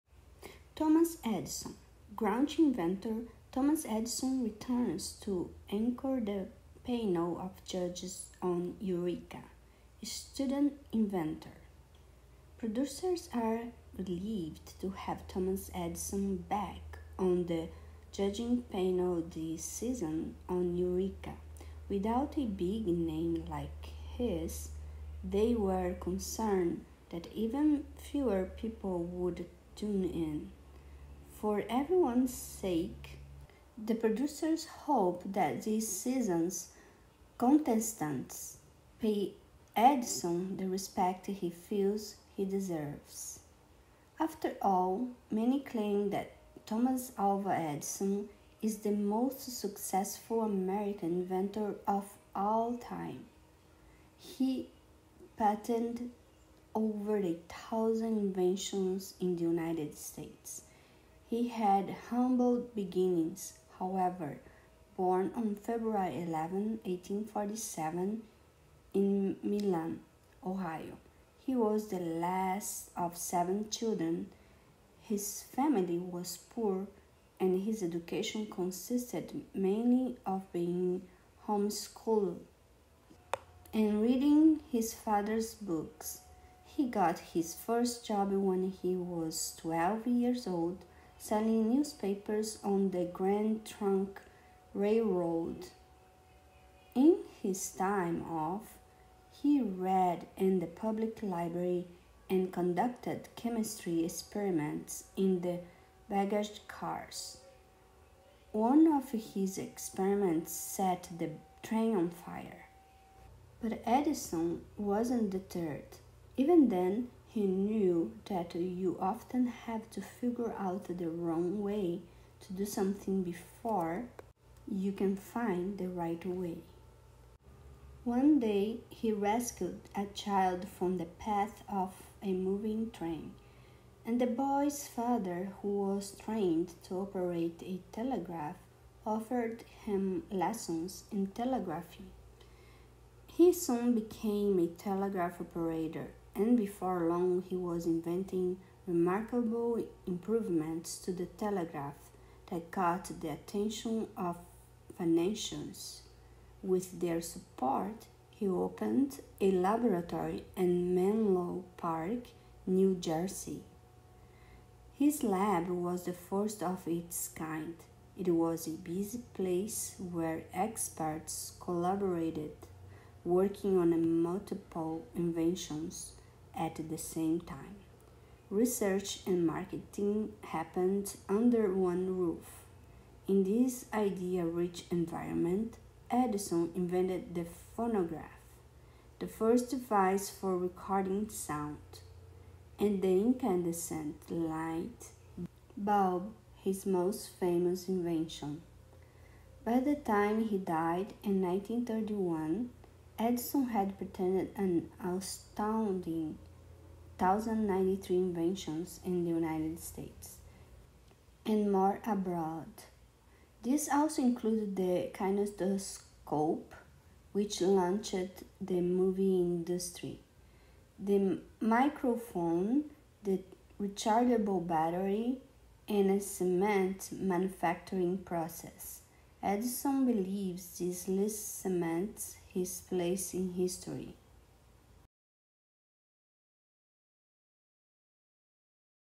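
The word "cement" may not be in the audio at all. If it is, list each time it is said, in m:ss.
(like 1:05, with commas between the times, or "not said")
3:46, 3:51.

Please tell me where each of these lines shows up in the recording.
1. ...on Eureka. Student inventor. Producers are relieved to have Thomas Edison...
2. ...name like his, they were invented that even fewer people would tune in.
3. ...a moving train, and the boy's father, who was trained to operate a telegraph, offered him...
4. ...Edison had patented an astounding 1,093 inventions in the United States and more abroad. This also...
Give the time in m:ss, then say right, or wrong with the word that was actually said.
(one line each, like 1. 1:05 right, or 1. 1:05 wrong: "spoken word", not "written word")
1. 0:08 right
2. 0:22 wrong: "concerned", not "invented"
3. 2:12 right
4. 3:23 right.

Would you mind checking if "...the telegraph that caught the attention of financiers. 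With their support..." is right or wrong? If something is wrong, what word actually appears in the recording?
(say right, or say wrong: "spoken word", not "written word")
right.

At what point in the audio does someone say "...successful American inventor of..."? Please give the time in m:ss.
0:49.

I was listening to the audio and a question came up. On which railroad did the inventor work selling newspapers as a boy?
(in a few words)
Grand Trunk Railroad.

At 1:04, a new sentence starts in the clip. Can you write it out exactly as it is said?
Born on February 11, 1847, in Milan, Ohio.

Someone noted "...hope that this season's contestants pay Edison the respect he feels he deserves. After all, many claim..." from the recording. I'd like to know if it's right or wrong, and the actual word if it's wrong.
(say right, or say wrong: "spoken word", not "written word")
right.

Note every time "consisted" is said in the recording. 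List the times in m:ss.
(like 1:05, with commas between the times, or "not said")
1:18.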